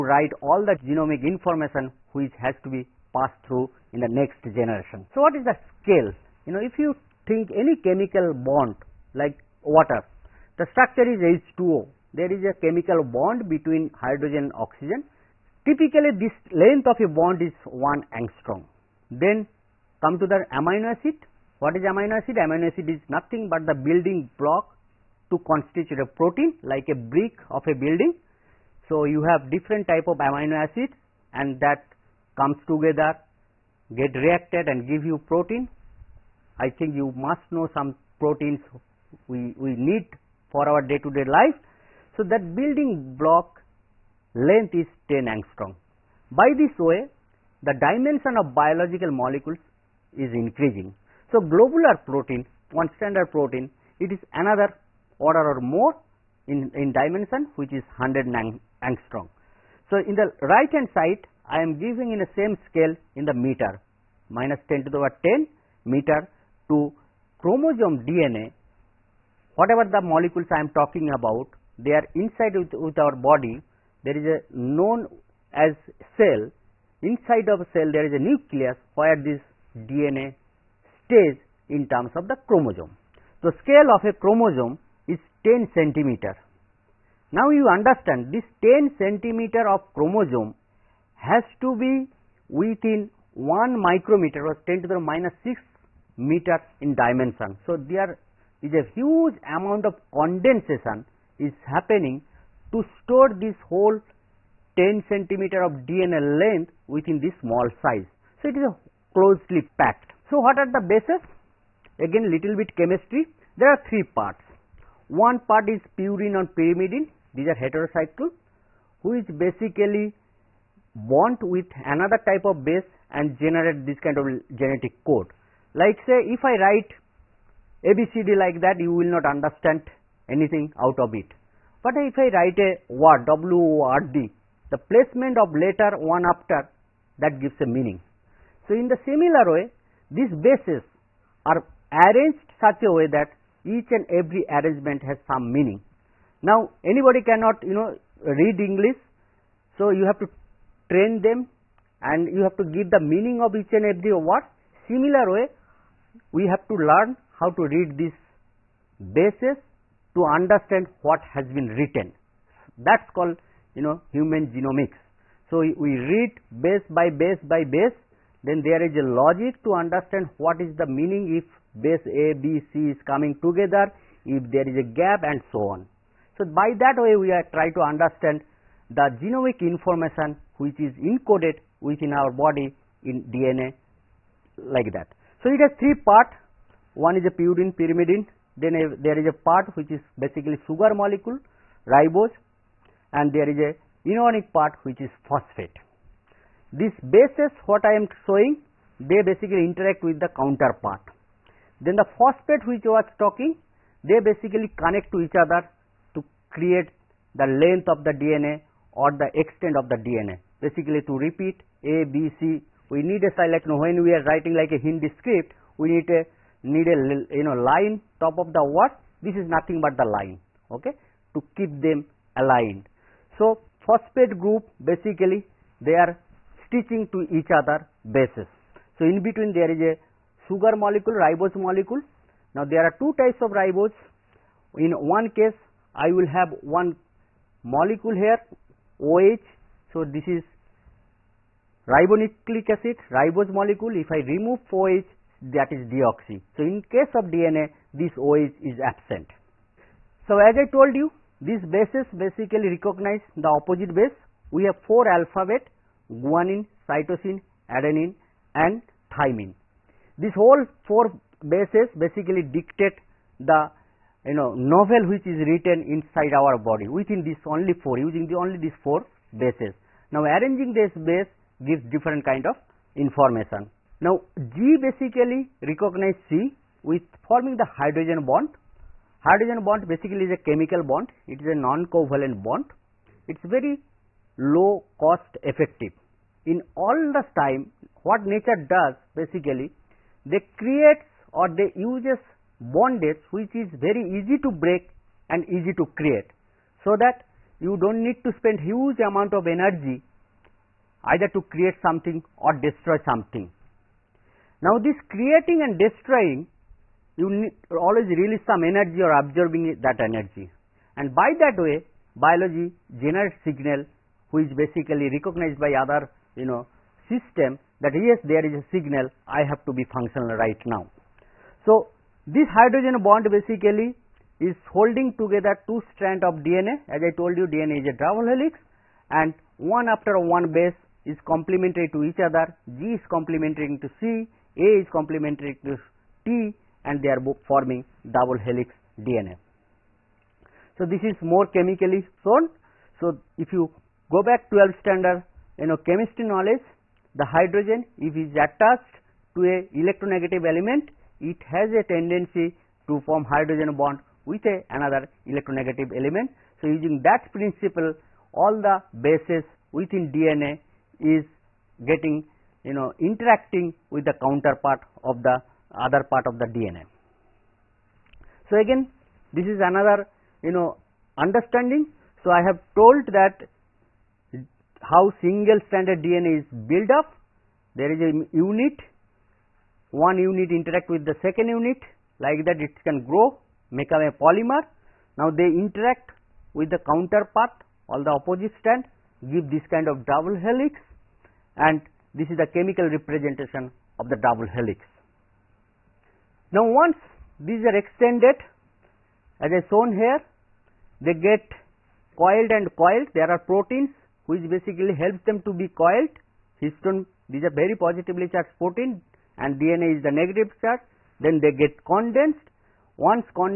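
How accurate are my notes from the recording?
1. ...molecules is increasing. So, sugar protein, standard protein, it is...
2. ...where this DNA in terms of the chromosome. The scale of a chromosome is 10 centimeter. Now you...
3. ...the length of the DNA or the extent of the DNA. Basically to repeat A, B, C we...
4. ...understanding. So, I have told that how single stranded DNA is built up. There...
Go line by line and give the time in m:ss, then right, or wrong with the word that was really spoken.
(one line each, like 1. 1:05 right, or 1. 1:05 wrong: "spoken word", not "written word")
1. 0:49 wrong: "globular", not "sugar"
2. 1:18 right
3. 3:27 right
4. 6:11 right.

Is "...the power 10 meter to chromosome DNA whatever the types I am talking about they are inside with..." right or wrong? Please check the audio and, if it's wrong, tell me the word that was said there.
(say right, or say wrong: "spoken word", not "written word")
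wrong: "molecules", not "types".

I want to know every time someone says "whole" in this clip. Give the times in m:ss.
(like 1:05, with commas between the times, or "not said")
1:43, 4:20.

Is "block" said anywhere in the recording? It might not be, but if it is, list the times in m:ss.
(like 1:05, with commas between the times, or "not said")
0:24, 0:43.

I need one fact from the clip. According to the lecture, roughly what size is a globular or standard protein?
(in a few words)
100 angstrom.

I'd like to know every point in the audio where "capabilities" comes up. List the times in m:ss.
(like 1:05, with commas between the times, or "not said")
not said.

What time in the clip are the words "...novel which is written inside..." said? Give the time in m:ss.
4:24.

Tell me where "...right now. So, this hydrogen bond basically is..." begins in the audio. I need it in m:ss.
5:20.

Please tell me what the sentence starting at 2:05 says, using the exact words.
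Like say if I write ABCD like that you will not understand anything out of it.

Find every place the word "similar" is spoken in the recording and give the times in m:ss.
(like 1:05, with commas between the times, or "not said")
2:19, 2:34.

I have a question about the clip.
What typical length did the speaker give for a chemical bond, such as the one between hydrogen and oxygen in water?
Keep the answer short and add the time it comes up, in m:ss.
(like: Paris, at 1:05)
1 angstrom, at 0:17.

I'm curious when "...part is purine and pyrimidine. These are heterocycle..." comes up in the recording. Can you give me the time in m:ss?
1:55.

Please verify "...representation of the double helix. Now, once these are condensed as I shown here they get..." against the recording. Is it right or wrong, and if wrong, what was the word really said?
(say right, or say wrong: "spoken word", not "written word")
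wrong: "extended", not "condensed".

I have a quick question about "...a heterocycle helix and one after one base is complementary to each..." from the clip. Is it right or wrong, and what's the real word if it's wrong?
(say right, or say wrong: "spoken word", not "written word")
wrong: "double", not "heterocycle".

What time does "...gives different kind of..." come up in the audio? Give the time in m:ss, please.
4:31.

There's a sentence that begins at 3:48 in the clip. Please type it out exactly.
So in between there is a sugar molecule, ribose molecule.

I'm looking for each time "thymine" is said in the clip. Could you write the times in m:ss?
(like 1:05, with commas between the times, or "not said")
4:19.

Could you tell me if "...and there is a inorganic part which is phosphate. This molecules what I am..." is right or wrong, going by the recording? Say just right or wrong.
wrong.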